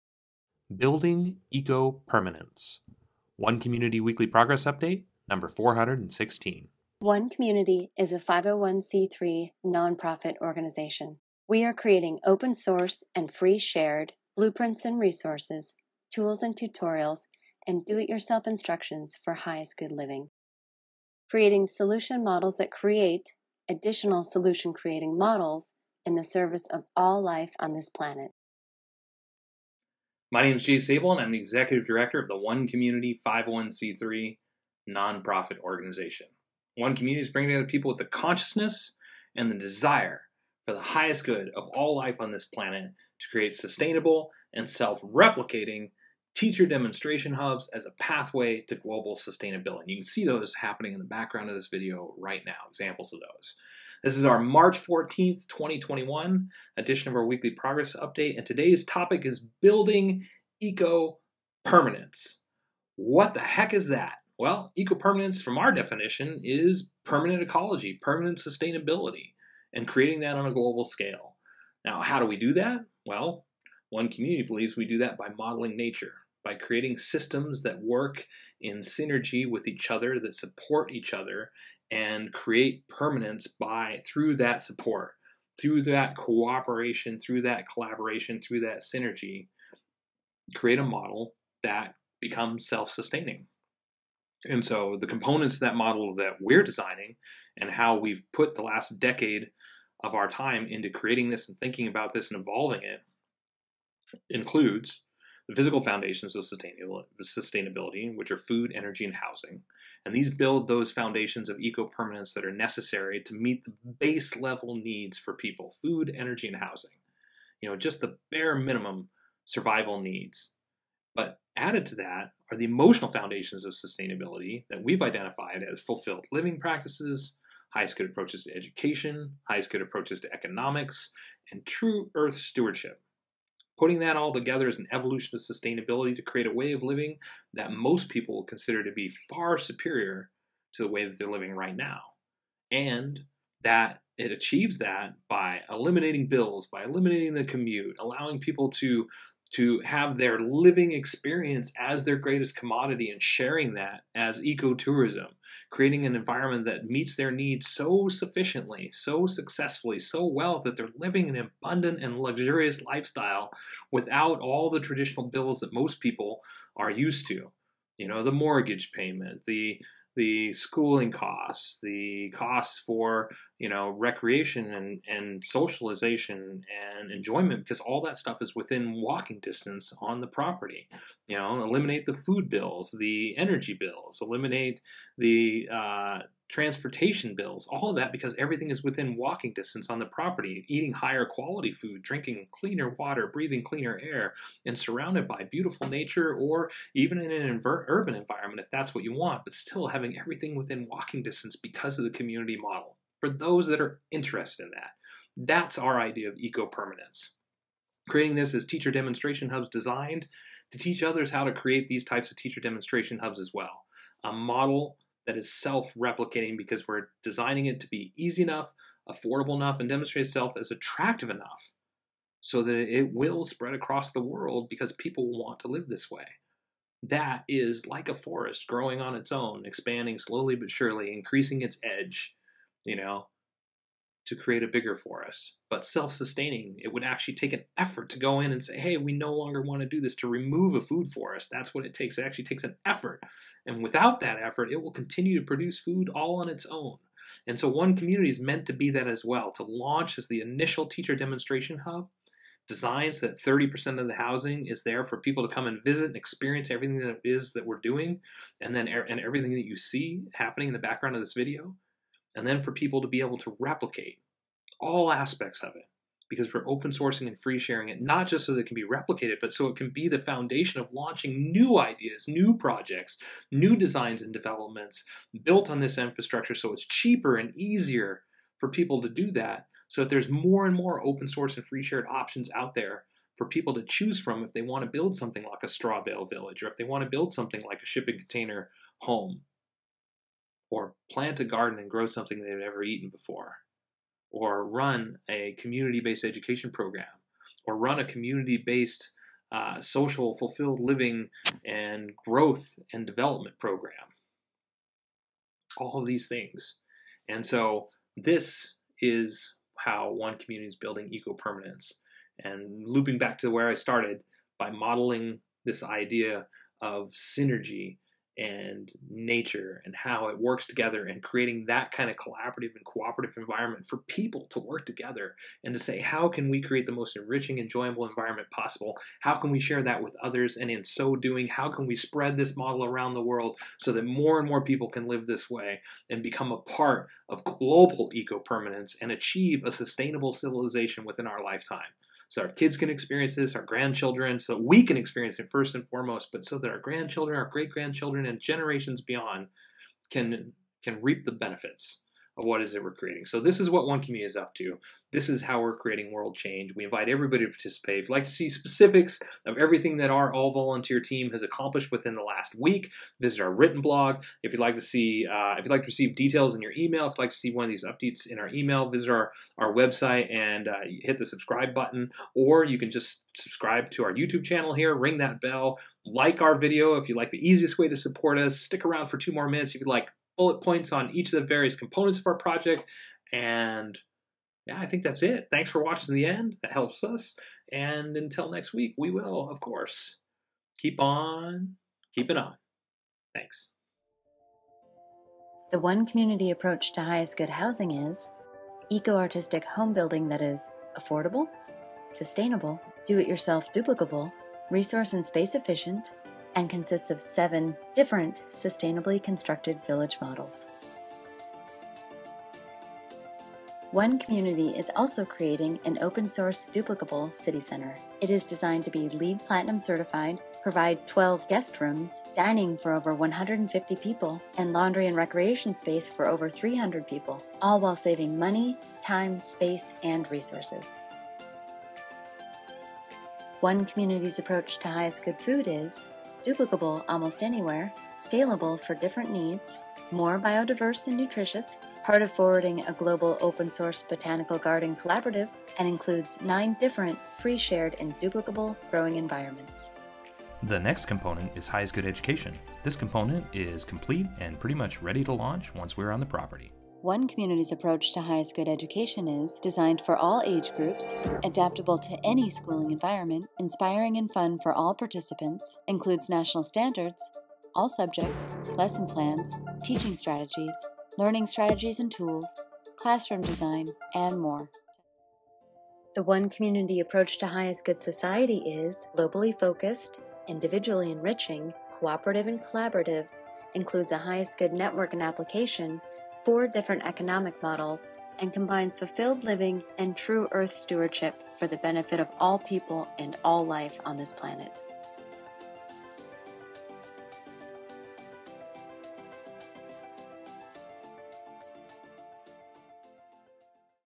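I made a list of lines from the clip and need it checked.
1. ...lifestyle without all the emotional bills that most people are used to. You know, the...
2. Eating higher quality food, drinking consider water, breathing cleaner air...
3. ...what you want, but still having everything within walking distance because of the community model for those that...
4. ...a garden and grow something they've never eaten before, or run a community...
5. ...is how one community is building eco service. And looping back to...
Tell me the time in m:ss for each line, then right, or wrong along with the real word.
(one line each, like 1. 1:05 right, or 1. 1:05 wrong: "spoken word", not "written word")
1. 2:42 wrong: "traditional", not "emotional"
2. 3:10 wrong: "cleaner", not "consider"
3. 3:18 right
4. 4:51 right
5. 5:09 wrong: "permanence", not "service".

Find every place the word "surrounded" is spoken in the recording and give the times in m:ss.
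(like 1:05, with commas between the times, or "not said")
3:14.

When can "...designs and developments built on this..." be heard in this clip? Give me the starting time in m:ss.
4:33.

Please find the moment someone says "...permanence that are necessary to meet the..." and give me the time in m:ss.
1:51.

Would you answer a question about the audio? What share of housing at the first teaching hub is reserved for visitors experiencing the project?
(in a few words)
30%.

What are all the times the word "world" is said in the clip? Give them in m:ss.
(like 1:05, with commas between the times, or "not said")
3:44, 5:33, 5:56.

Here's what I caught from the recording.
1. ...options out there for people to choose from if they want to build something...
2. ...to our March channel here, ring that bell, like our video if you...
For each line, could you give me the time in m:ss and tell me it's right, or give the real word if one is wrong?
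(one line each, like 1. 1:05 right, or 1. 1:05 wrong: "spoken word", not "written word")
1. 4:42 right
2. 6:13 wrong: "YouTube", not "March".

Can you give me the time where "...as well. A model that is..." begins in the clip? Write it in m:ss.
3:33.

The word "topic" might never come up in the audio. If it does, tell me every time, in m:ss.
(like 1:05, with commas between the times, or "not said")
0:58.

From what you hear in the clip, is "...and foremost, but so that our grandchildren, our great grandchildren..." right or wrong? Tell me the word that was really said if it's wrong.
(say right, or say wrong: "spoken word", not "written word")
right.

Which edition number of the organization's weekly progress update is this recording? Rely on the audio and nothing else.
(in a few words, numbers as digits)
416.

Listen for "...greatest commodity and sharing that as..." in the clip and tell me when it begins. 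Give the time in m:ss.
2:32.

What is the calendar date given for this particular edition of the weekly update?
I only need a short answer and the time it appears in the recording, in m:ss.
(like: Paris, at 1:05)
March 14th, 2021, at 0:54.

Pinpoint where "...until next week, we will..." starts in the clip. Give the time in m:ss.
6:28.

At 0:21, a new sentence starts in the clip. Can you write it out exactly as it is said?
Creating solution models that create additional solution creating models in the service of all life on this planet.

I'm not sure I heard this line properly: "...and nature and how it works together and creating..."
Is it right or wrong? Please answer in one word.
right.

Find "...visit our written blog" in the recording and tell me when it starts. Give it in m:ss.
6:03.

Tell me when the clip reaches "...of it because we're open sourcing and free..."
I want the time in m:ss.
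4:25.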